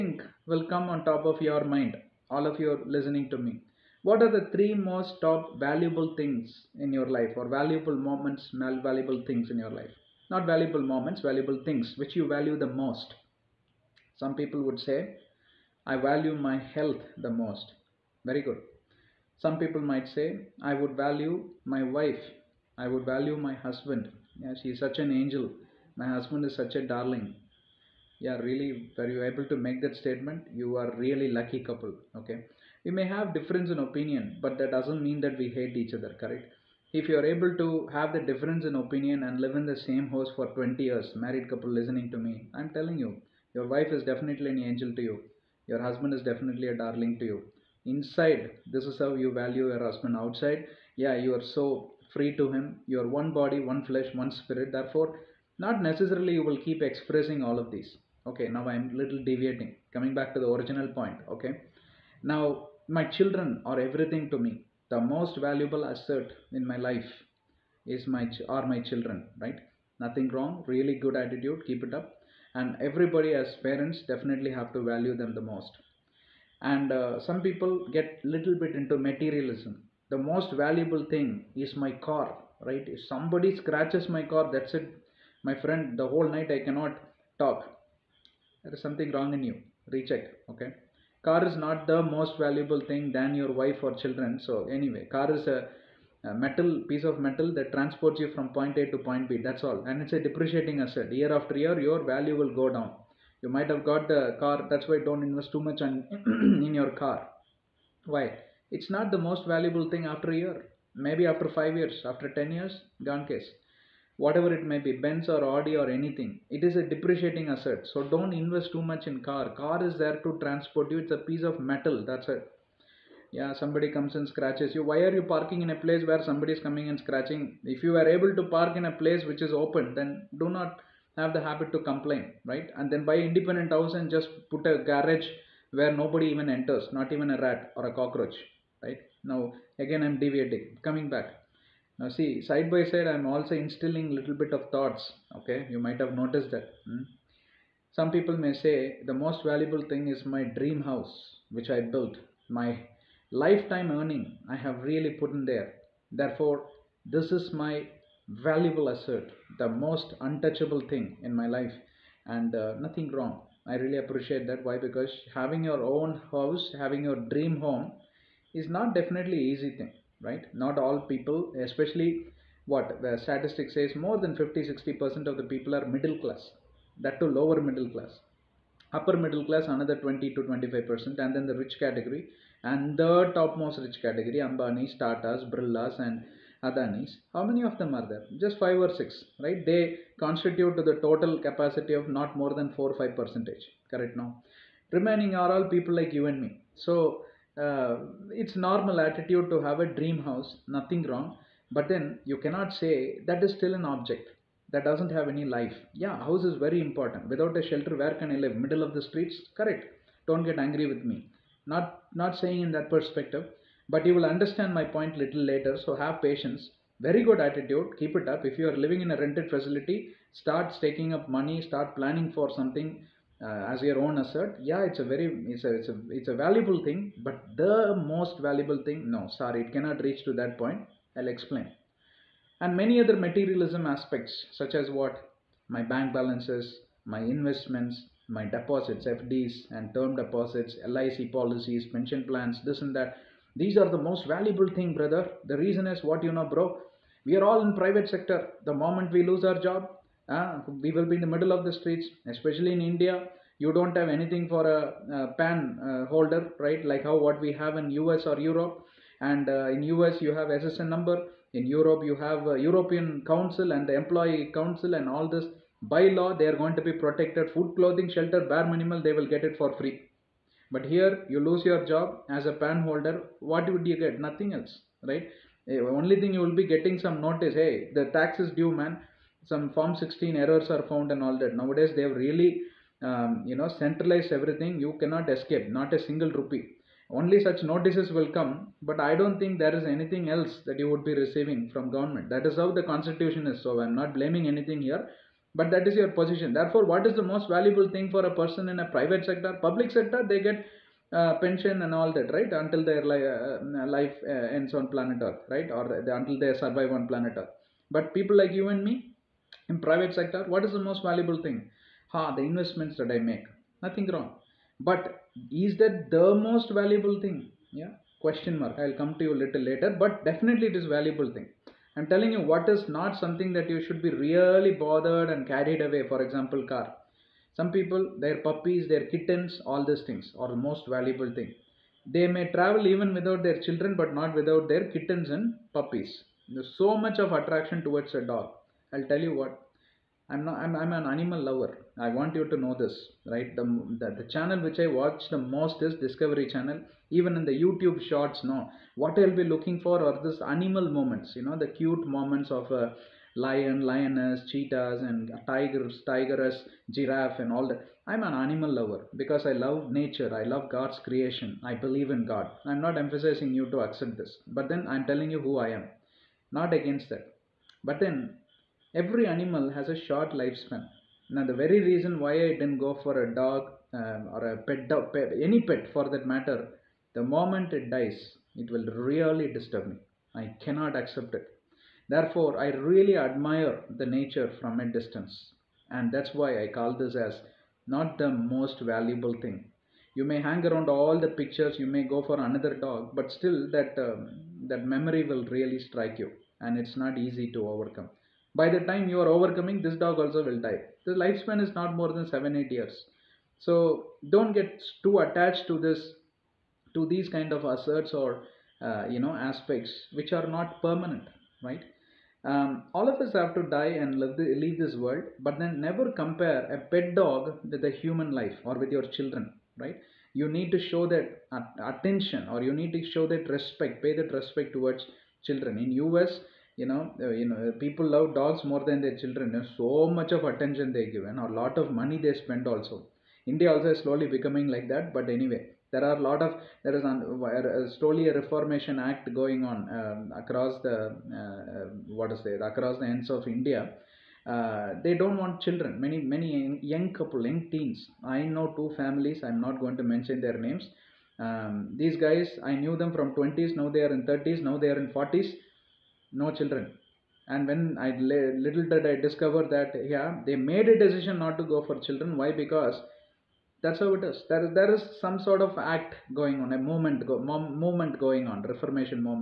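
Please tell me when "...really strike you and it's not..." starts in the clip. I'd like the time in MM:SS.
06:35.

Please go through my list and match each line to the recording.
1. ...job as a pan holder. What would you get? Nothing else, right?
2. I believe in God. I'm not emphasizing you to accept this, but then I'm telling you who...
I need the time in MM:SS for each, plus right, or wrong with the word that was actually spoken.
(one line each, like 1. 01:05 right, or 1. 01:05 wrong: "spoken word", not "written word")
1. 04:31 right
2. 06:01 right.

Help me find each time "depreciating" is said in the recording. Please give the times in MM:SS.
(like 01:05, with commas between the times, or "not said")
01:40, 01:56.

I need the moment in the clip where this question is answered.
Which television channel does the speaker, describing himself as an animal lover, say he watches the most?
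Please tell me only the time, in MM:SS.
05:46.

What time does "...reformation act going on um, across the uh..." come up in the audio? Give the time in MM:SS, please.
07:18.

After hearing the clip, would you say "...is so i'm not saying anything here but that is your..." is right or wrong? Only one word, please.
wrong.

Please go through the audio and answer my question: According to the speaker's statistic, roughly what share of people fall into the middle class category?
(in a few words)
50 60 percent.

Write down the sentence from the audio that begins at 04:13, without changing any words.
You don't have anything for a, a pan uh, holder, right?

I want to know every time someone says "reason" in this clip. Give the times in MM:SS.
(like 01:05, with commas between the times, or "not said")
04:05, 06:11.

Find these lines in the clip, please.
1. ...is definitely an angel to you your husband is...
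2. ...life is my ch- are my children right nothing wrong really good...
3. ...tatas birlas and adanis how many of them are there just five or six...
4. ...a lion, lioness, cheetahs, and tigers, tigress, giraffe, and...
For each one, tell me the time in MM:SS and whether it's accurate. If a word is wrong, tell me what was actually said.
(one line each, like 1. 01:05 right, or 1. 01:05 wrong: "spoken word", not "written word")
1. 00:43 right
2. 01:06 right
3. 03:05 right
4. 05:52 right.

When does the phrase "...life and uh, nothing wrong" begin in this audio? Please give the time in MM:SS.
02:41.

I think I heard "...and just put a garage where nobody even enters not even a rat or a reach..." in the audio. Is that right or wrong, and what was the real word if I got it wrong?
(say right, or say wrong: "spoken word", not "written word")
wrong: "cockroach", not "reach".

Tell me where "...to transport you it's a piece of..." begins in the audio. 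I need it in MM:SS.
02:00.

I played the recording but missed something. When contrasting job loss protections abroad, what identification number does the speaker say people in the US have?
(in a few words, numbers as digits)
SSN number.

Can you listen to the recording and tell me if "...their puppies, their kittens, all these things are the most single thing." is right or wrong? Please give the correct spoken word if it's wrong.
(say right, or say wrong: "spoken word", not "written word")
wrong: "valuable", not "single".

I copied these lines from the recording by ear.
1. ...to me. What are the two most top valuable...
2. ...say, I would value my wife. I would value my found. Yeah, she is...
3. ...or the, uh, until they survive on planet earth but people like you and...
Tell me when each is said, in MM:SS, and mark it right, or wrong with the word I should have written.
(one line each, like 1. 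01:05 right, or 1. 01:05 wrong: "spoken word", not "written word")
1. 00:03 wrong: "three", not "two"
2. 00:20 wrong: "husband", not "found"
3. 05:05 right.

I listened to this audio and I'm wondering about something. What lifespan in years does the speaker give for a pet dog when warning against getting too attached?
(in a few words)
7 8 years.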